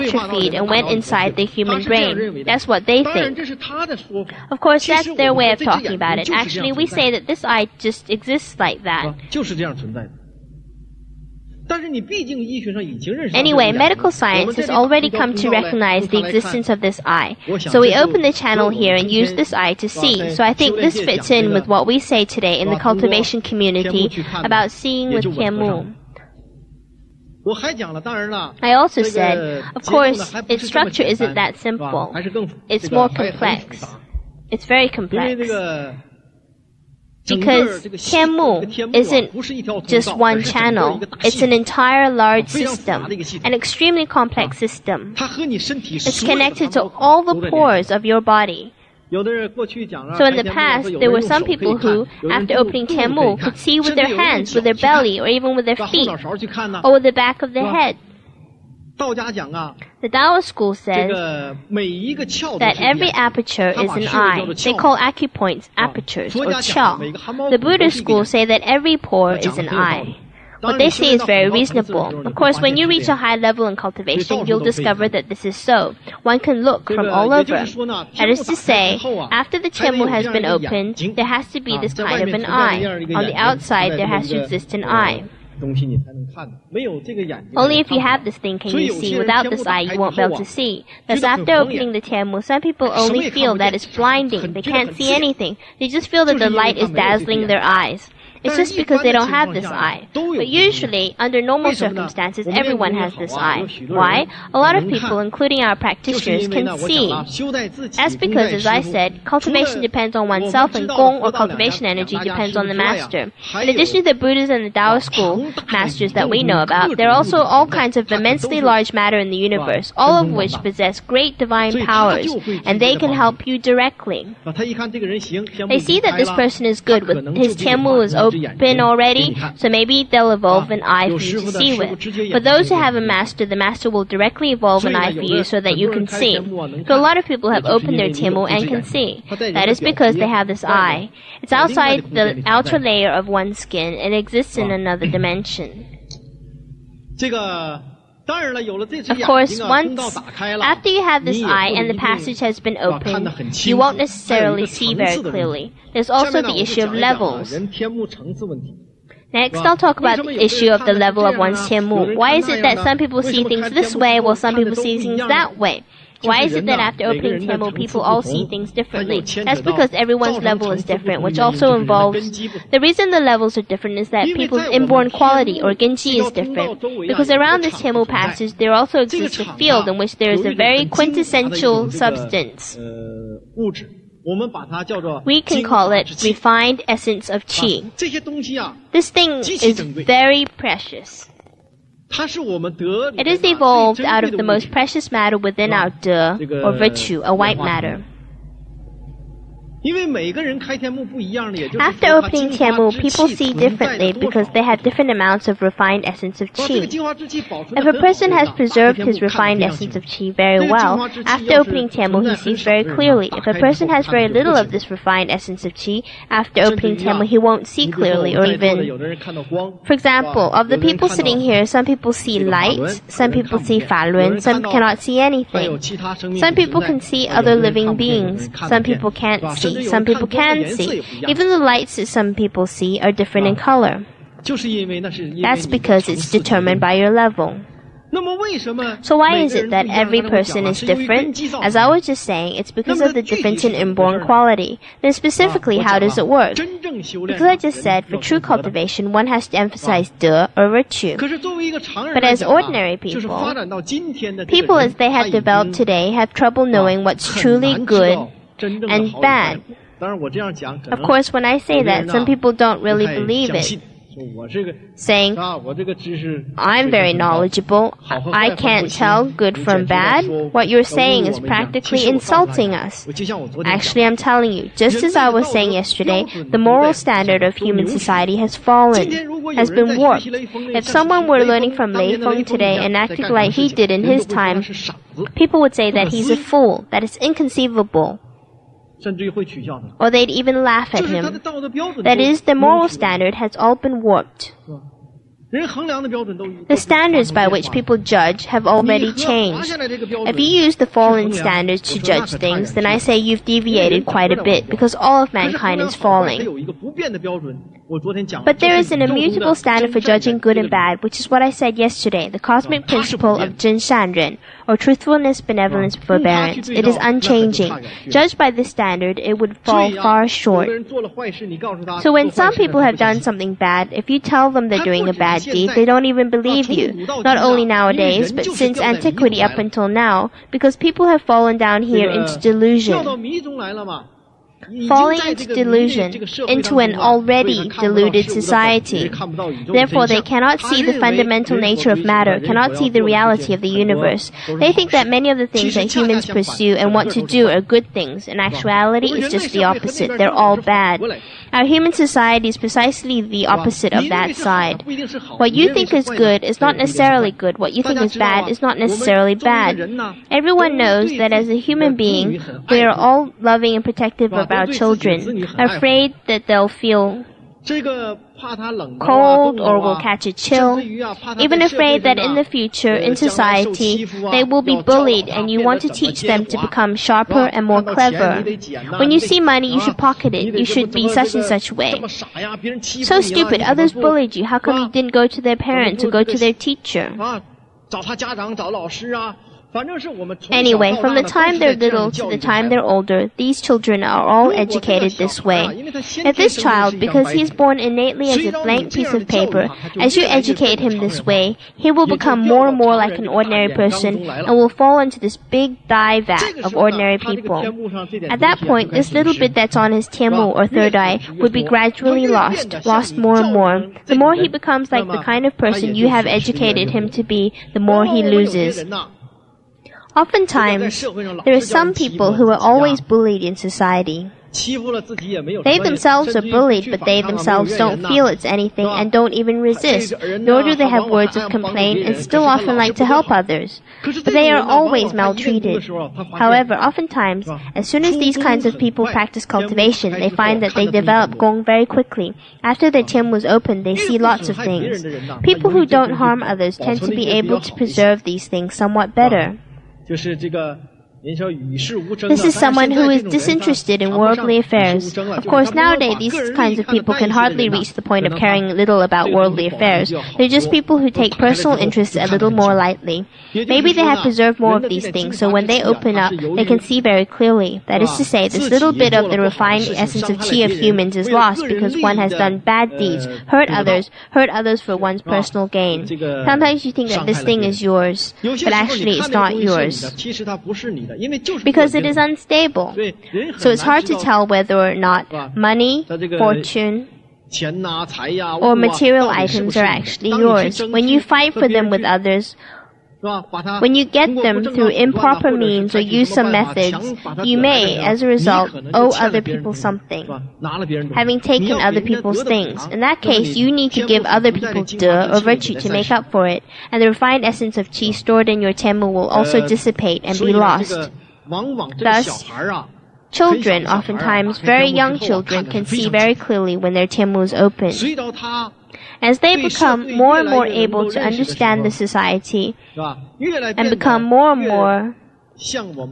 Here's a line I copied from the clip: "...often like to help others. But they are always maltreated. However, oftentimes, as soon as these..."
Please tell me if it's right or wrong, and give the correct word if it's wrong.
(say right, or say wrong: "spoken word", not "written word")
right.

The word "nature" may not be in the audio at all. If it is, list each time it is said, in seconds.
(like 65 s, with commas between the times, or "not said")
341 s.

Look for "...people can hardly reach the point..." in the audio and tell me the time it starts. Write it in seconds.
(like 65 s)
456 s.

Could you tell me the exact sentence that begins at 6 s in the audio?
Actually, we say that this eye just exists like that.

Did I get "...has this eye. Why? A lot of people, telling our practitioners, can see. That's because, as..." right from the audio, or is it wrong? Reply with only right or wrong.
wrong.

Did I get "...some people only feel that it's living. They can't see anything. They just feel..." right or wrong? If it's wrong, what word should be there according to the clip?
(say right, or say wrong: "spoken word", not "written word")
wrong: "blinding", not "living".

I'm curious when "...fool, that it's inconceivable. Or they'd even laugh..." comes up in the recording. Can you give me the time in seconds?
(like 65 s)
286 s.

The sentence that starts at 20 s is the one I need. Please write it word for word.
So I think this fits in with what we say today in the cultivation community about seeing with Tianmu.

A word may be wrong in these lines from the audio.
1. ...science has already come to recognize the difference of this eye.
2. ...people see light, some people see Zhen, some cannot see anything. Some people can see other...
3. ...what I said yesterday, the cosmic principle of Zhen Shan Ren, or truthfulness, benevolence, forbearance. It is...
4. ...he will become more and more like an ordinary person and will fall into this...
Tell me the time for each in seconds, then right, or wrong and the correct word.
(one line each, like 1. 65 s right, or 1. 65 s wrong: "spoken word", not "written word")
1. 14 s wrong: "existence", not "difference"
2. 221 s wrong: "Falun", not "Zhen"
3. 311 s right
4. 401 s right.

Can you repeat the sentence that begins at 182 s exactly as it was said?
Uh, we can call it refined essence of qi.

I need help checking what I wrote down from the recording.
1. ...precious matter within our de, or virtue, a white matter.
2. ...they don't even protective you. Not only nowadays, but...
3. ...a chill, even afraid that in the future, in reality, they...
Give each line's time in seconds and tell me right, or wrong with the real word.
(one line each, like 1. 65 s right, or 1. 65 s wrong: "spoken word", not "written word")
1. 194 s right
2. 325 s wrong: "believe", not "protective"
3. 370 s wrong: "society", not "reality".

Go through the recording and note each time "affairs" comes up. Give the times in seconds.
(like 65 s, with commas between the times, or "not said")
454 s, 459 s.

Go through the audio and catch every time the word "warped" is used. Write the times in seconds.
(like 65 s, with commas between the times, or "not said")
279 s, 294 s.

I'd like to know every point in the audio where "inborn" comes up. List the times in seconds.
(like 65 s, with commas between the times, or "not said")
174 s, 243 s.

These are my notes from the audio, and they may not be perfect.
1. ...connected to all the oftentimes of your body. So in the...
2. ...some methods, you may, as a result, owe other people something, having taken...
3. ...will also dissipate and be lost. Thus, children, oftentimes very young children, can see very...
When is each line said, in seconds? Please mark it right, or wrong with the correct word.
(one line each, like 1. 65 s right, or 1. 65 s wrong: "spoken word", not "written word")
1. 46 s wrong: "pores", not "oftentimes"
2. 496 s right
3. 509 s right.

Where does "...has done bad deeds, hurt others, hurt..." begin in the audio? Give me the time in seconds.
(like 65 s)
472 s.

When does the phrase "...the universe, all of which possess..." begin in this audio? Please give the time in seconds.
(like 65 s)
119 s.